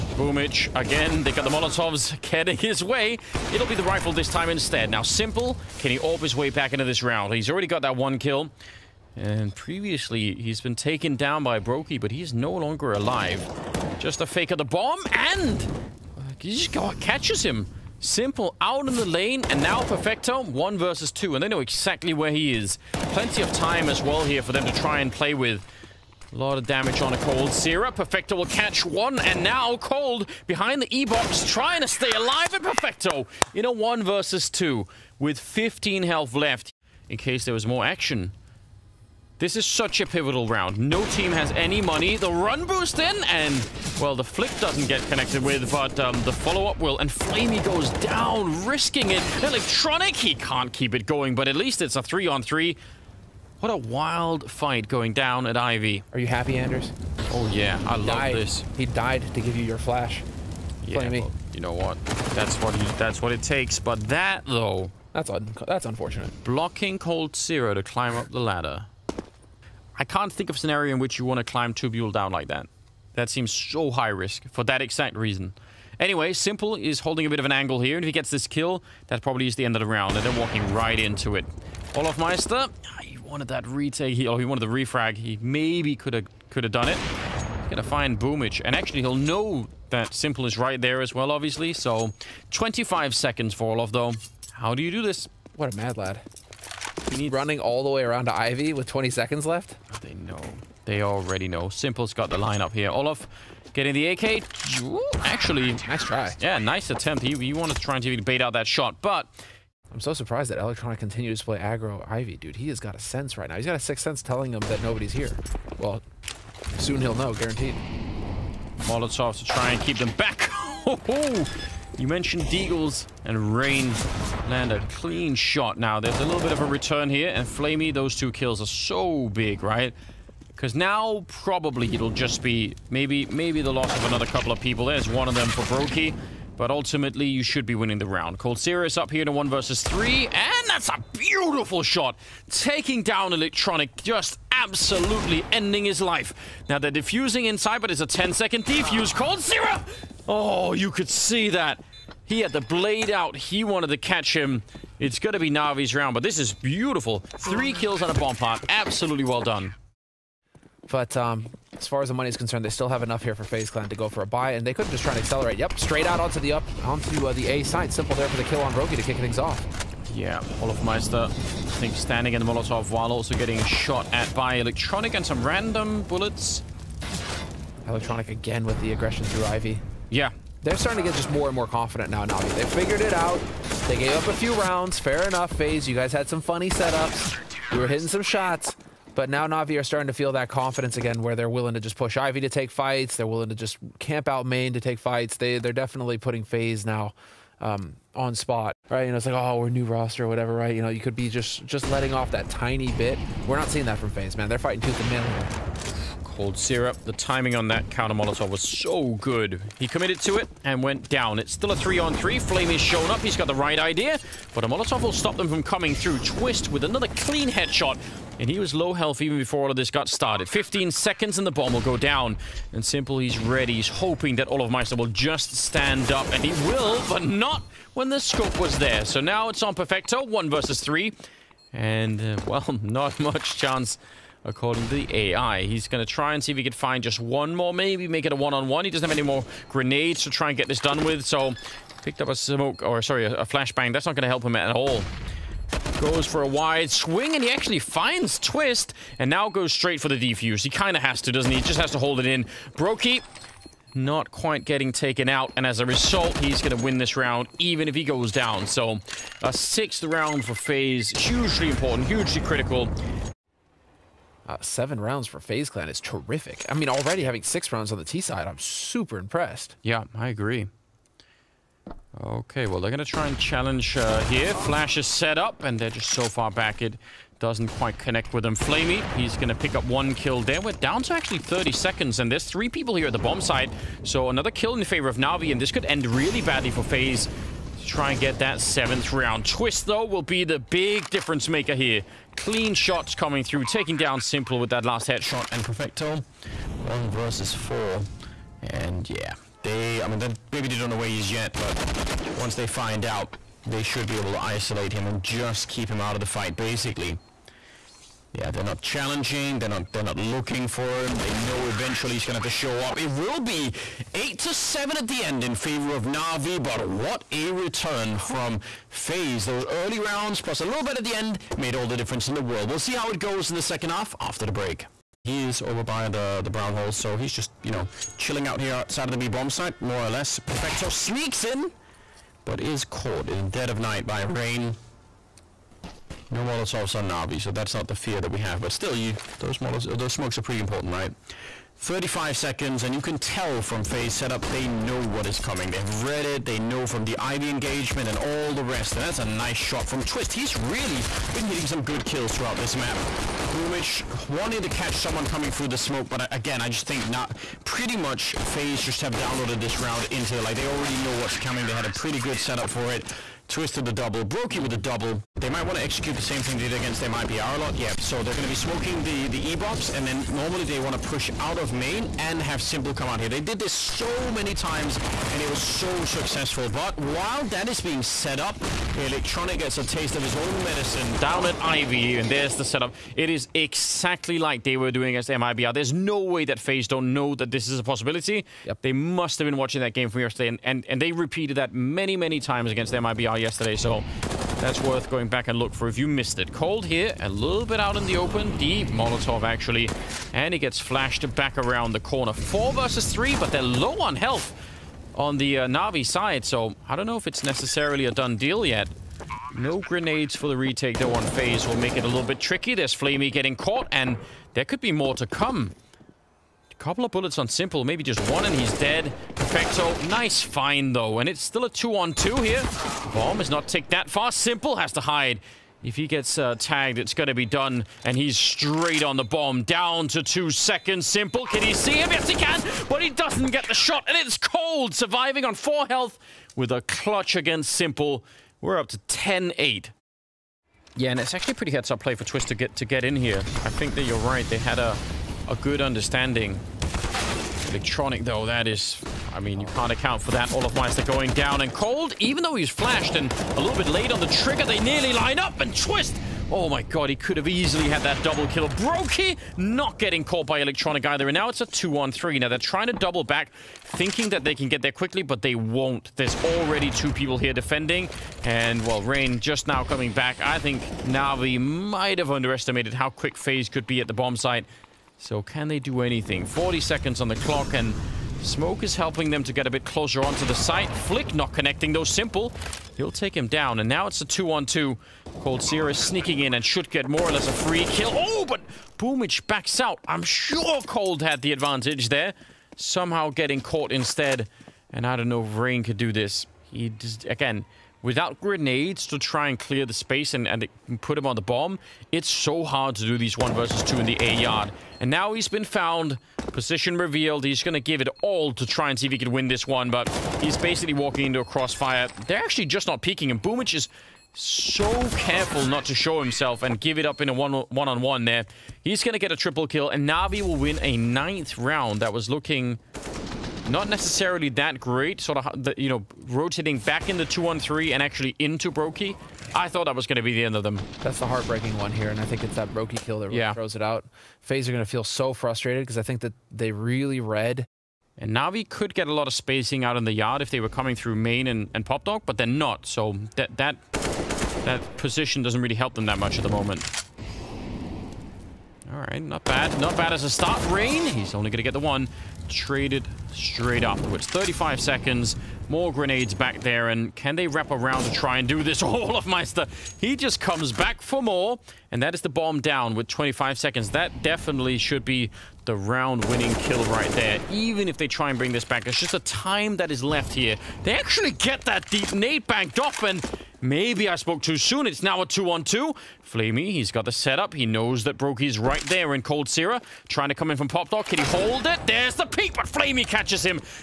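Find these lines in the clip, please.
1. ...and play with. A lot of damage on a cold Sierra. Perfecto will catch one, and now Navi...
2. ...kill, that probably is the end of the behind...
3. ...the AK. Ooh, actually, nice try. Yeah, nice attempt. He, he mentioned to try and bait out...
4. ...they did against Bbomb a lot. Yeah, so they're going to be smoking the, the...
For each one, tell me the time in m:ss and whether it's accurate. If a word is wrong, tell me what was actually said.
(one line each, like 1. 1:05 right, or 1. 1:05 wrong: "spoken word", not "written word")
1. 0:24 wrong: "Cold", not "Navi"
2. 1:18 wrong: "round", not "behind"
3. 1:43 wrong: "wanted", not "mentioned"
4. 6:06 wrong: "MIBR", not "Bbomb".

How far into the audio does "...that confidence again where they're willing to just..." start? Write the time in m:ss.
3:10.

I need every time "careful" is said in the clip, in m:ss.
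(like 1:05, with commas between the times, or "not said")
8:35.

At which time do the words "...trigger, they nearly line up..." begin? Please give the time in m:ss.
7:34.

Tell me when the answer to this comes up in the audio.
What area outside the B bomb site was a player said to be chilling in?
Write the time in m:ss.
5:26.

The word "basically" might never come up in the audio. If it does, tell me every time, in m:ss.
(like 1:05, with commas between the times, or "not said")
5:06, 8:30.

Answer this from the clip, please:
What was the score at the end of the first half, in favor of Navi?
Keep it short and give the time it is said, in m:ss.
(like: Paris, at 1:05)
8 to 7, at 5:14.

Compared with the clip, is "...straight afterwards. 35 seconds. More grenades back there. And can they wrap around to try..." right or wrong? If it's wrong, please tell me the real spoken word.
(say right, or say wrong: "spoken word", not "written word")
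right.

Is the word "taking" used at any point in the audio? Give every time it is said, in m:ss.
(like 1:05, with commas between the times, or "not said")
2:22, 4:53.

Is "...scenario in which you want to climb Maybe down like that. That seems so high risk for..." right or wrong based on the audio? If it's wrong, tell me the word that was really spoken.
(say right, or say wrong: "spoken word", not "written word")
wrong: "Tubule", not "Maybe".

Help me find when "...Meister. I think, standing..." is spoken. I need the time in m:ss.
2:50.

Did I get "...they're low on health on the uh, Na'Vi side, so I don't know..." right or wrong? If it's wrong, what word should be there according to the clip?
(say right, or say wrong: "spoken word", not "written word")
right.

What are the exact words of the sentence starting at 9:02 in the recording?
So that, that, that position doesn't really help them that much at the moment.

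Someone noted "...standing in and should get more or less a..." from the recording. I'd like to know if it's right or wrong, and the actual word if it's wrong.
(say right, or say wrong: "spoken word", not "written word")
wrong: "sneaking", not "standing".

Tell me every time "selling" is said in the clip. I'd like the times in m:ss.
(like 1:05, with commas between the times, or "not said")
not said.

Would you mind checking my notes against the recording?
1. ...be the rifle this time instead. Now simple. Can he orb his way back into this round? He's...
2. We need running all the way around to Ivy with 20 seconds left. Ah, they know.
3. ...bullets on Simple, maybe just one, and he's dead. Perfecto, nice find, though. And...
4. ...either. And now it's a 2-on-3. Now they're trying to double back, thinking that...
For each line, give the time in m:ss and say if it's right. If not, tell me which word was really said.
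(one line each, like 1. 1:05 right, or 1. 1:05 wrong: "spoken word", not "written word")
1. 0:03 right
2. 1:37 right
3. 6:57 right
4. 7:41 right.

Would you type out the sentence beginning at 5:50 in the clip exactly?
He's really been hitting some good kills throughout this map.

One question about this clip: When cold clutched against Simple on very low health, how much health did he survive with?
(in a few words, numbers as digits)
4.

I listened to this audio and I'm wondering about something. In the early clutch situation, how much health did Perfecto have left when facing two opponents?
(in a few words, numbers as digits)
15.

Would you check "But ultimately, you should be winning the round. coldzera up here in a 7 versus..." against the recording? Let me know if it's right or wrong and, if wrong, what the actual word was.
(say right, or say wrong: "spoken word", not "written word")
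wrong: "1", not "7".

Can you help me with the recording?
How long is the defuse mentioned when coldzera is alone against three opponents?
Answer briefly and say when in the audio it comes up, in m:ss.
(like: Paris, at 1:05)
10 seconds, at 2:28.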